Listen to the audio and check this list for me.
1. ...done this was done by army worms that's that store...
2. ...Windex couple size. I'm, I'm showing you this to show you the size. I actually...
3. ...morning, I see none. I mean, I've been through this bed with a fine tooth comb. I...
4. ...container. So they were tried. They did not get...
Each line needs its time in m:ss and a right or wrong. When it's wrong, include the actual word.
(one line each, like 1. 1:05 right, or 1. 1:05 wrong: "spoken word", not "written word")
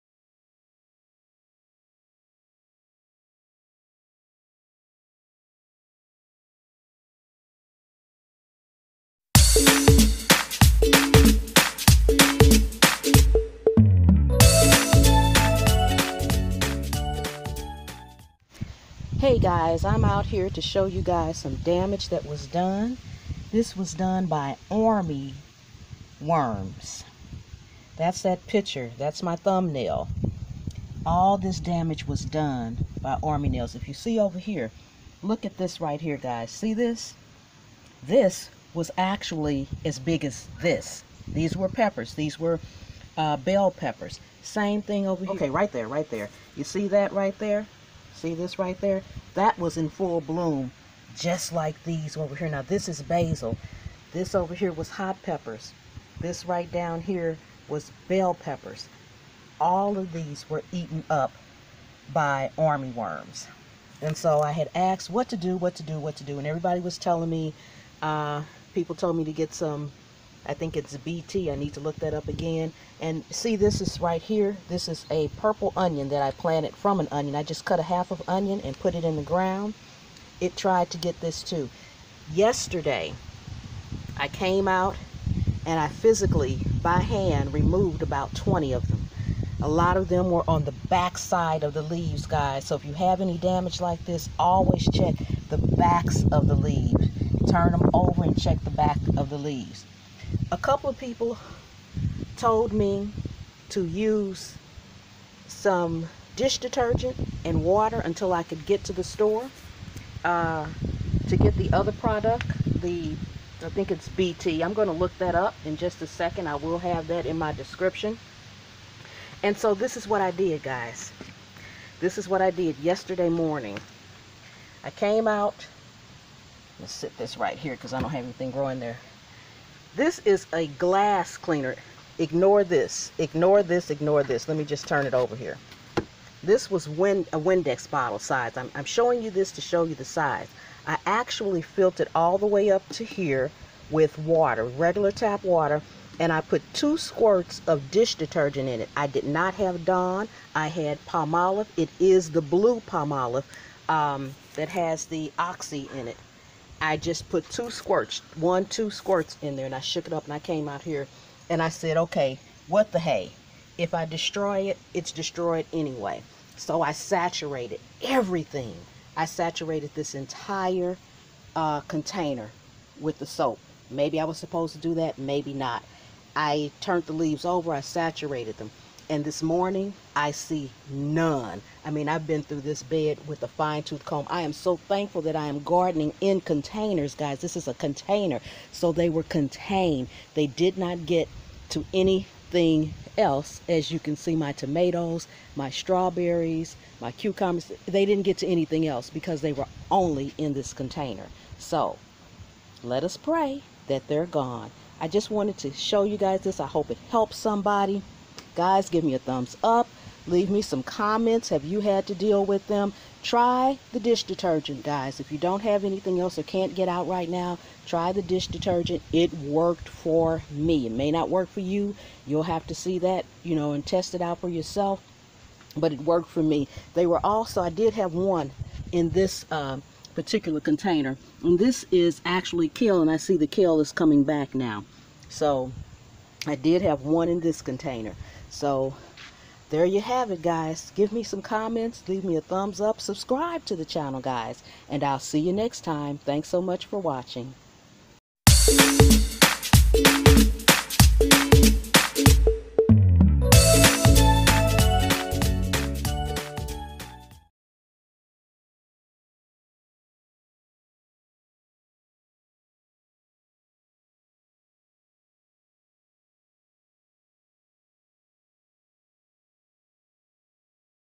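1. 0:22 wrong: "picture", not "store"
2. 2:16 wrong: "bottle", not "couple"
3. 2:59 right
4. 3:07 wrong: "contained", not "tried".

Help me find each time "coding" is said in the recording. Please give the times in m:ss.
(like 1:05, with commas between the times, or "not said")
not said.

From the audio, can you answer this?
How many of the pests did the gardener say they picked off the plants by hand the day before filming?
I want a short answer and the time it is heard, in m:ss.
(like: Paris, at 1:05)
20, at 1:28.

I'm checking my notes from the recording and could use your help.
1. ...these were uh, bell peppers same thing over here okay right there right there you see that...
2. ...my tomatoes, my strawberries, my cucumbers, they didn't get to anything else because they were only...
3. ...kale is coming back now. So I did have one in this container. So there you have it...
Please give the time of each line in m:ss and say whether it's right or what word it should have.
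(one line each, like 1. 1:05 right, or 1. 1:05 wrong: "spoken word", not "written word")
1. 0:42 right
2. 3:14 right
3. 3:53 right.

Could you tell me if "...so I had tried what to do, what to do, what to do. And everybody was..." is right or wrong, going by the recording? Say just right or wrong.
wrong.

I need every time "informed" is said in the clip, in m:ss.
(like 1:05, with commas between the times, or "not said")
not said.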